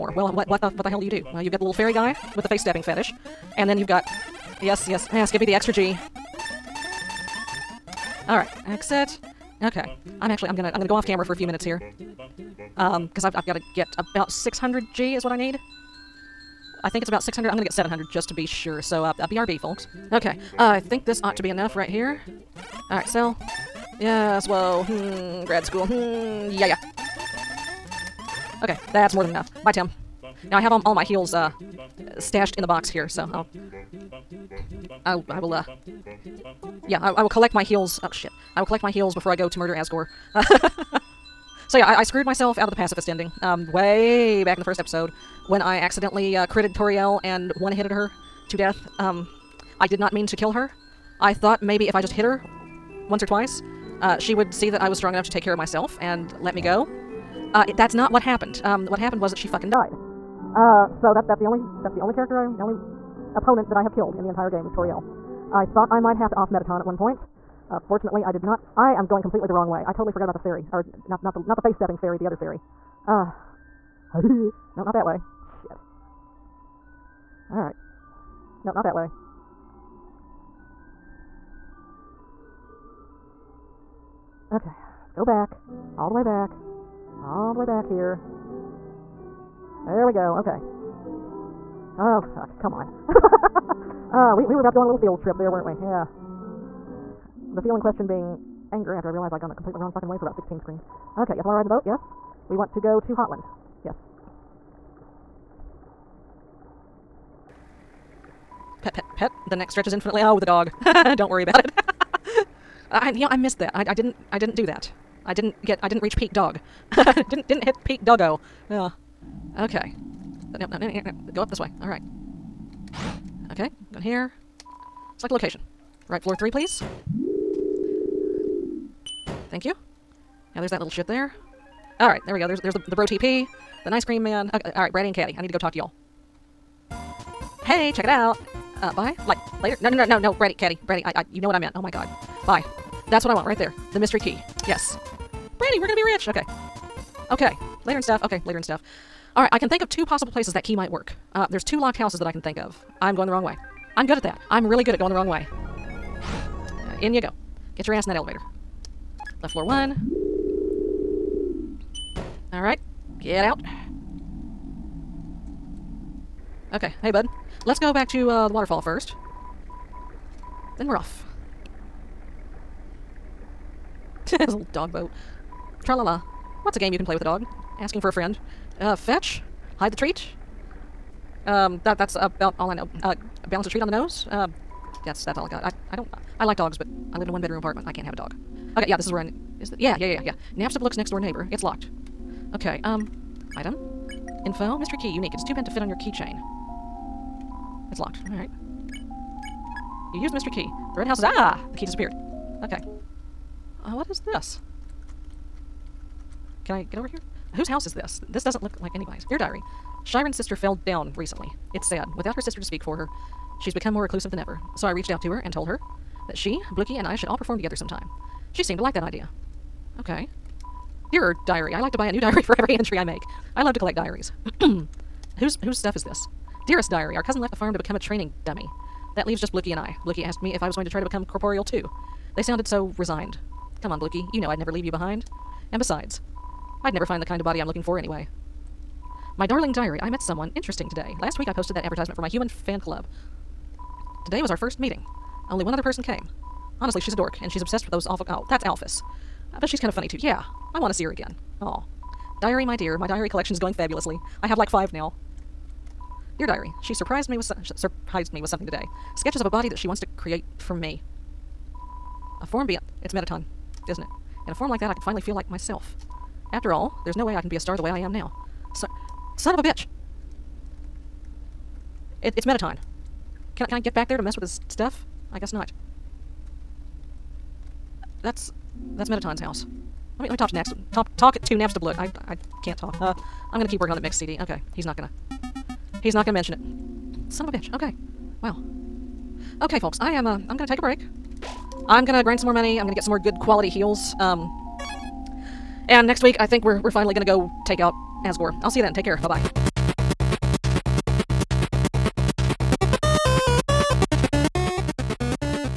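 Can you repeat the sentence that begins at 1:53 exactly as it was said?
I, I didn't, I didn't do that.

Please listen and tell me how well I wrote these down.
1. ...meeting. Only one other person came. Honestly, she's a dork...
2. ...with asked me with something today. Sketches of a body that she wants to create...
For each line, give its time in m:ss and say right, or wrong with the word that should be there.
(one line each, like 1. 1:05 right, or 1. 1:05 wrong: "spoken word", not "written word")
1. 4:04 right
2. 4:17 wrong: "surprised", not "asked".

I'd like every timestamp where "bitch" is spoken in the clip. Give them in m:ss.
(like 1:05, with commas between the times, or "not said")
4:29, 4:47.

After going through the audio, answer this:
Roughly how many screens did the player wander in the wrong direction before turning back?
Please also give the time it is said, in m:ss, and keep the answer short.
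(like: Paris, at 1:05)
16, at 1:40.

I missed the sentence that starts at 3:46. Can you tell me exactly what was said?
Dearest diary, our cousin left the farm to become a training dummy.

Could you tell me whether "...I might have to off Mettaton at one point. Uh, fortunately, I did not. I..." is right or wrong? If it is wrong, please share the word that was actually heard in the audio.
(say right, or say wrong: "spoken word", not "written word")
right.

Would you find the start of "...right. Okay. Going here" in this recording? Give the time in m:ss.
2:01.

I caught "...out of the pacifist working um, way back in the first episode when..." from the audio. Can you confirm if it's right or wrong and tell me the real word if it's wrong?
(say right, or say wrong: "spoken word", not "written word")
wrong: "ending", not "working".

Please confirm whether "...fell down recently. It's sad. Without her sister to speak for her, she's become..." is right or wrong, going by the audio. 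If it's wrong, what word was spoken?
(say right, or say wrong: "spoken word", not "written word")
right.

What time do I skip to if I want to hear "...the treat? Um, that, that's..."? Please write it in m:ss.
2:59.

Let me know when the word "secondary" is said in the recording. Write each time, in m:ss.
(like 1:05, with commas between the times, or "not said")
not said.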